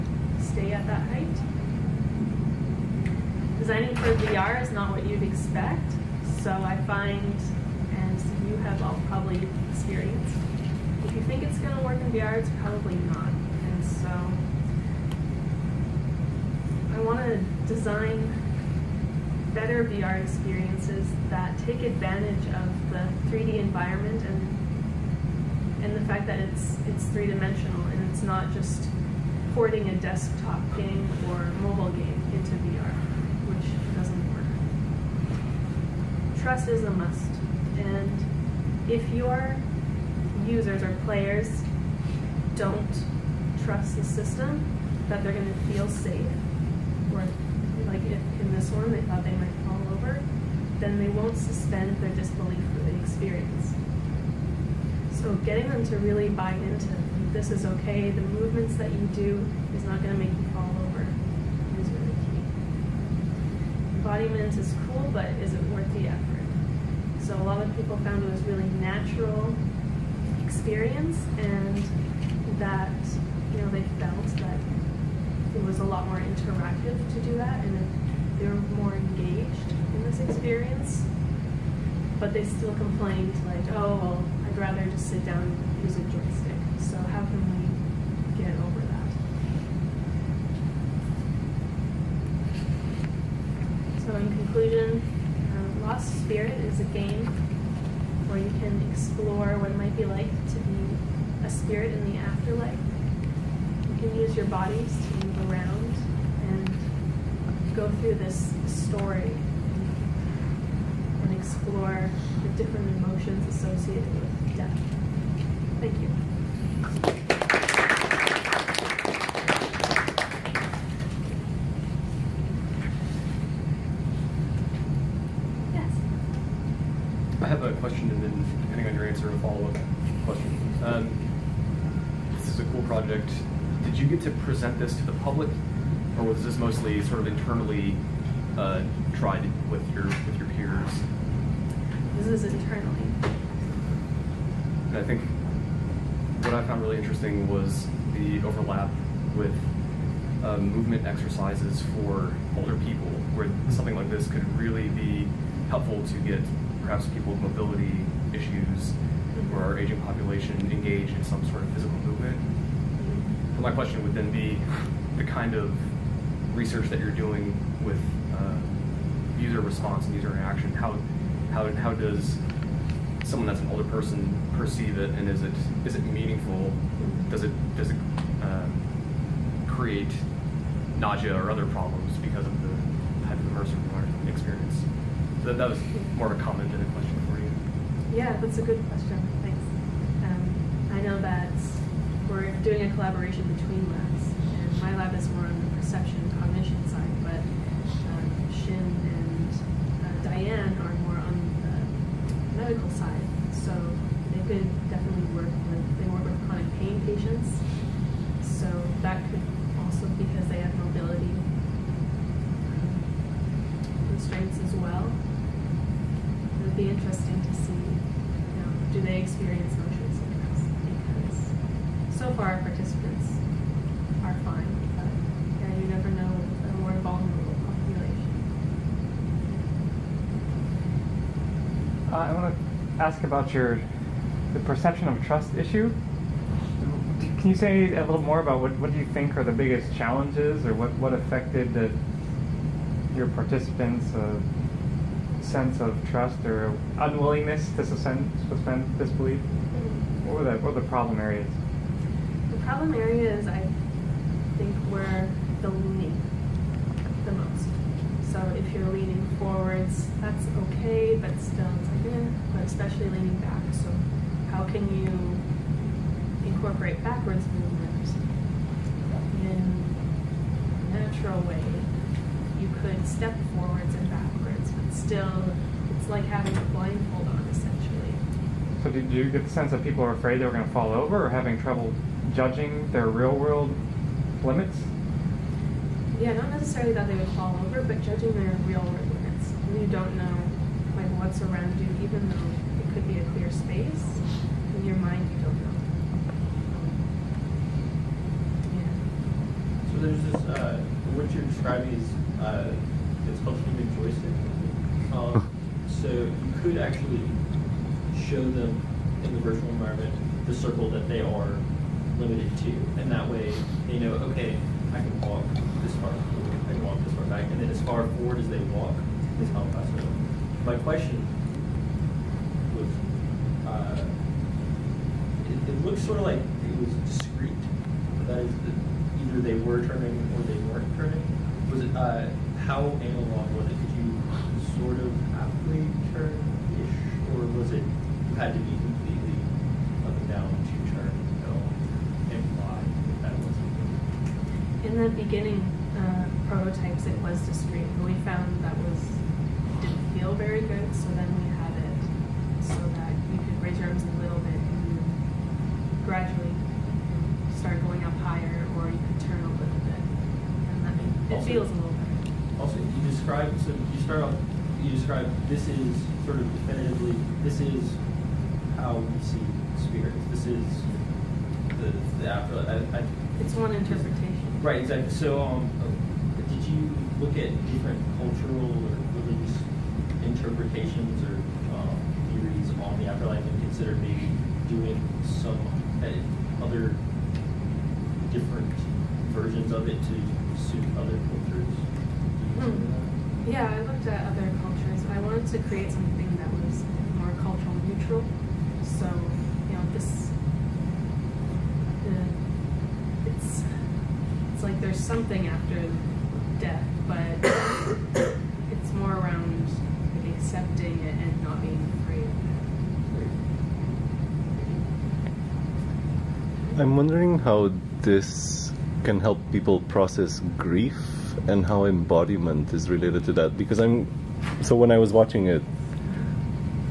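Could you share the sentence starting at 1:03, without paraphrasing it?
Embodiment is cool, but is it worth the effort?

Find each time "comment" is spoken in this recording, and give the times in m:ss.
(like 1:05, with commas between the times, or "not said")
3:06.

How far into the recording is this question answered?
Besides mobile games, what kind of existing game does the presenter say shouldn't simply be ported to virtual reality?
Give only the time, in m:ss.
0:29.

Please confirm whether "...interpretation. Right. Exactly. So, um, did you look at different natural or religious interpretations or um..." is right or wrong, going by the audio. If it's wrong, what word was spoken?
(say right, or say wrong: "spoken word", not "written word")
wrong: "cultural", not "natural".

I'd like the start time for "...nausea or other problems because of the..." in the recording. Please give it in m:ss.
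3:00.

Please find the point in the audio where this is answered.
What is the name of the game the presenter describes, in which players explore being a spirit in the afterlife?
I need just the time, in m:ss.
1:35.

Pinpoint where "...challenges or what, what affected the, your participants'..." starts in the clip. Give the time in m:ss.
3:59.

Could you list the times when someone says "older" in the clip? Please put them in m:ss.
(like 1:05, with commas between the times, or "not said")
2:32, 2:53.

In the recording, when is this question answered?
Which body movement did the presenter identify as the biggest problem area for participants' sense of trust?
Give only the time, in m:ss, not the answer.
4:23.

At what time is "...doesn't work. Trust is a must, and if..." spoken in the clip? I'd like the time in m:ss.
0:33.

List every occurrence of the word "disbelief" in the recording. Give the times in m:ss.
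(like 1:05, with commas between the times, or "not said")
0:52, 4:08.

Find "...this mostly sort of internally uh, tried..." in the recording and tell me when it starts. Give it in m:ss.
2:16.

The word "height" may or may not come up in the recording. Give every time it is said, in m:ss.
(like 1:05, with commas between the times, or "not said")
0:01.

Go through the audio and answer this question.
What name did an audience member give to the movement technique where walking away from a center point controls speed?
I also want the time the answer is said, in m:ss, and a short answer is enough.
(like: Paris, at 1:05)
human joystick, at 5:03.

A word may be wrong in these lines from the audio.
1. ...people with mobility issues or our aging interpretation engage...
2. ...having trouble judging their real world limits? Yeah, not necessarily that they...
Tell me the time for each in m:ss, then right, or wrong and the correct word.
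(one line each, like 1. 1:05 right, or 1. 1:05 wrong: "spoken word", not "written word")
1. 2:37 wrong: "population", not "interpretation"
2. 4:41 right.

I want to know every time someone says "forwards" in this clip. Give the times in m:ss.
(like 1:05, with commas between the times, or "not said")
4:19, 4:33, 5:18.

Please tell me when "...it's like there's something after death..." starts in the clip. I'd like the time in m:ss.
6:44.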